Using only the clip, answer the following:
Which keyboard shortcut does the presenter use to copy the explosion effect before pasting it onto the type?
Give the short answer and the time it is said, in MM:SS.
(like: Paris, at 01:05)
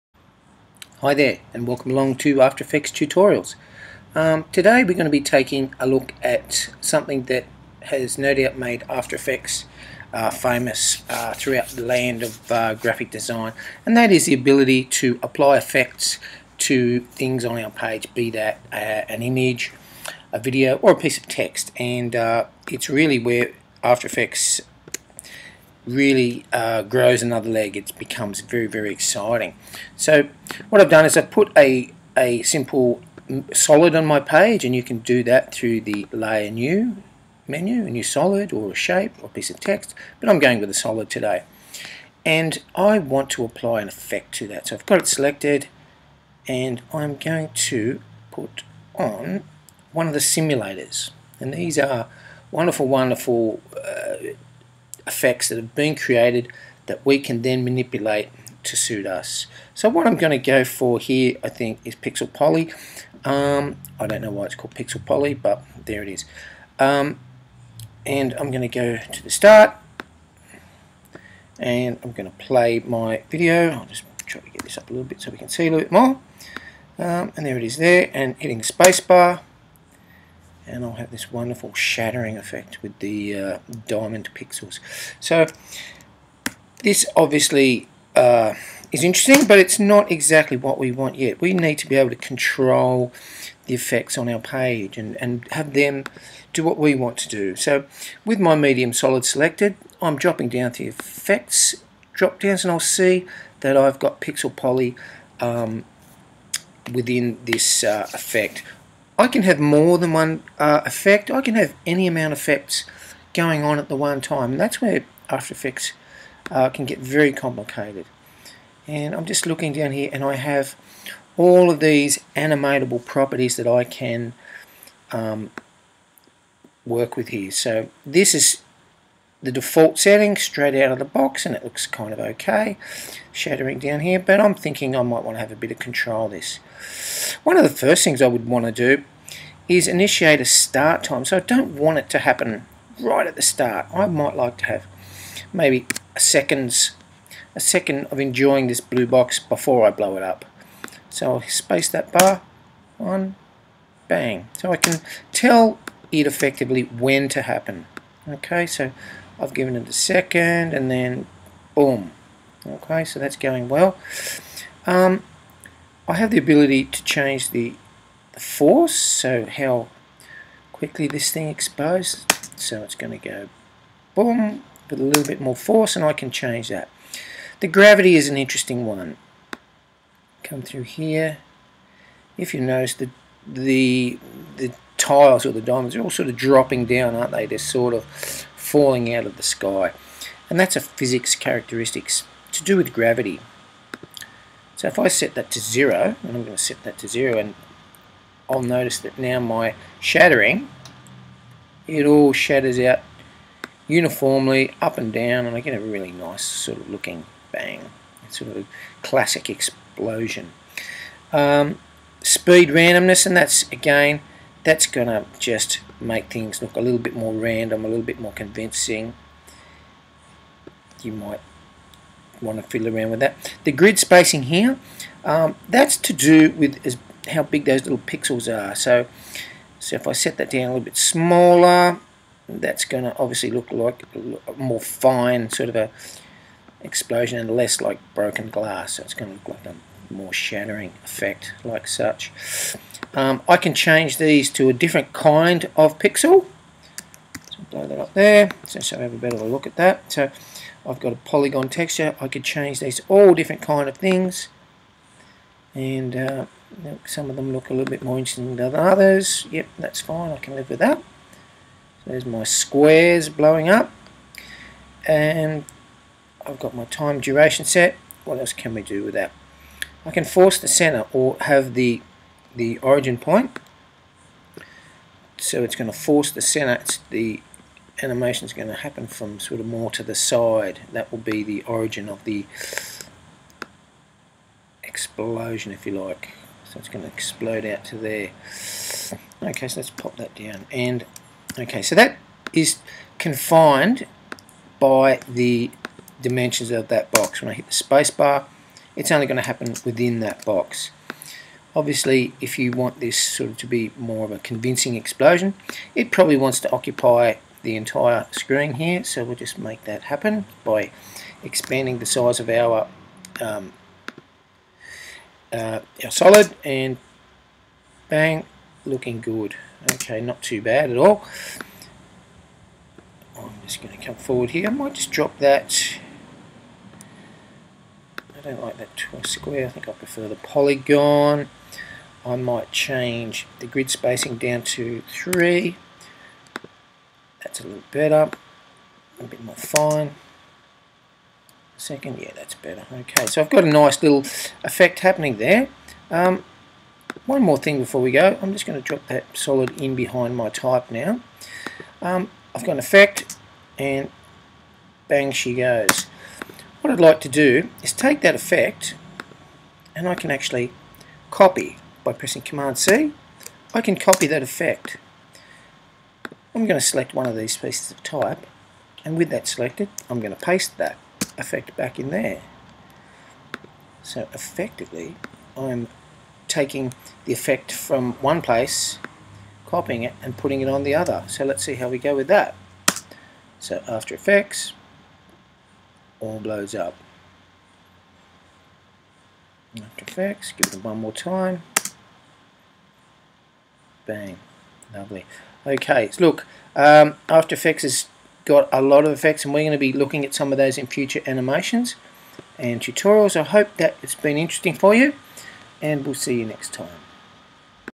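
Command C, at 06:02.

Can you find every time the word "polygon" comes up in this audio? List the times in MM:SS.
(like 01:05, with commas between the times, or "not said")
04:11, 05:30.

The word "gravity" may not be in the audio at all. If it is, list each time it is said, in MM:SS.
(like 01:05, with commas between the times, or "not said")
02:57, 03:12.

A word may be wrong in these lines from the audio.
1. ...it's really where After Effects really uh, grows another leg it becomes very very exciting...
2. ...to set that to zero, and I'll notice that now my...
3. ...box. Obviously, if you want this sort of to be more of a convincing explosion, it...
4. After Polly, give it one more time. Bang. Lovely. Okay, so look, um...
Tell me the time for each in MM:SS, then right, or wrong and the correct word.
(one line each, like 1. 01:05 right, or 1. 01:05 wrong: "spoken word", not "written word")
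1. 00:22 right
2. 03:16 right
3. 05:00 right
4. 06:29 wrong: "Effects", not "Polly".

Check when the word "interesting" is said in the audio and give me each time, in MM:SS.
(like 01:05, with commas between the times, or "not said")
01:29, 02:58, 04:18, 06:44.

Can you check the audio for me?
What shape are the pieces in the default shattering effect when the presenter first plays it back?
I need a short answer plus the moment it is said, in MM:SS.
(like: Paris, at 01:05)
diamond, at 01:23.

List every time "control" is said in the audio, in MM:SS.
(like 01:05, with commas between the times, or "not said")
01:32, 02:15.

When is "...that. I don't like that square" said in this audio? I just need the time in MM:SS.
05:25.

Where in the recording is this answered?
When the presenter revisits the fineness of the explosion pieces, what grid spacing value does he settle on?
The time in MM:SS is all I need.
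05:35.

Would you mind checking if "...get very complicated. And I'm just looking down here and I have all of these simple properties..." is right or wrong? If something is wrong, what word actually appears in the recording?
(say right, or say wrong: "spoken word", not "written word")
wrong: "animatable", not "simple".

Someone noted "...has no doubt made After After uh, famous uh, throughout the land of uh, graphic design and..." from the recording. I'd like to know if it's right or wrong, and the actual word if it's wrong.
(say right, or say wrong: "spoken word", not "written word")
wrong: "Effects", not "After".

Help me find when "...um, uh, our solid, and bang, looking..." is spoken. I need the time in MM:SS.
05:13.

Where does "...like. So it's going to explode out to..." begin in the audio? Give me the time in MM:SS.
04:45.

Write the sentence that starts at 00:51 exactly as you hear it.
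And these are wonderful, wonderful uh, effects that have been created that we can then manipulate to suit us.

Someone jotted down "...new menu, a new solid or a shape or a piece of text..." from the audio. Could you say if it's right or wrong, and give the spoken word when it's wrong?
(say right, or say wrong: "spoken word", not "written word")
right.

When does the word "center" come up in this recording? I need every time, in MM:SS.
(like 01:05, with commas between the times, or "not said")
04:30, 04:36.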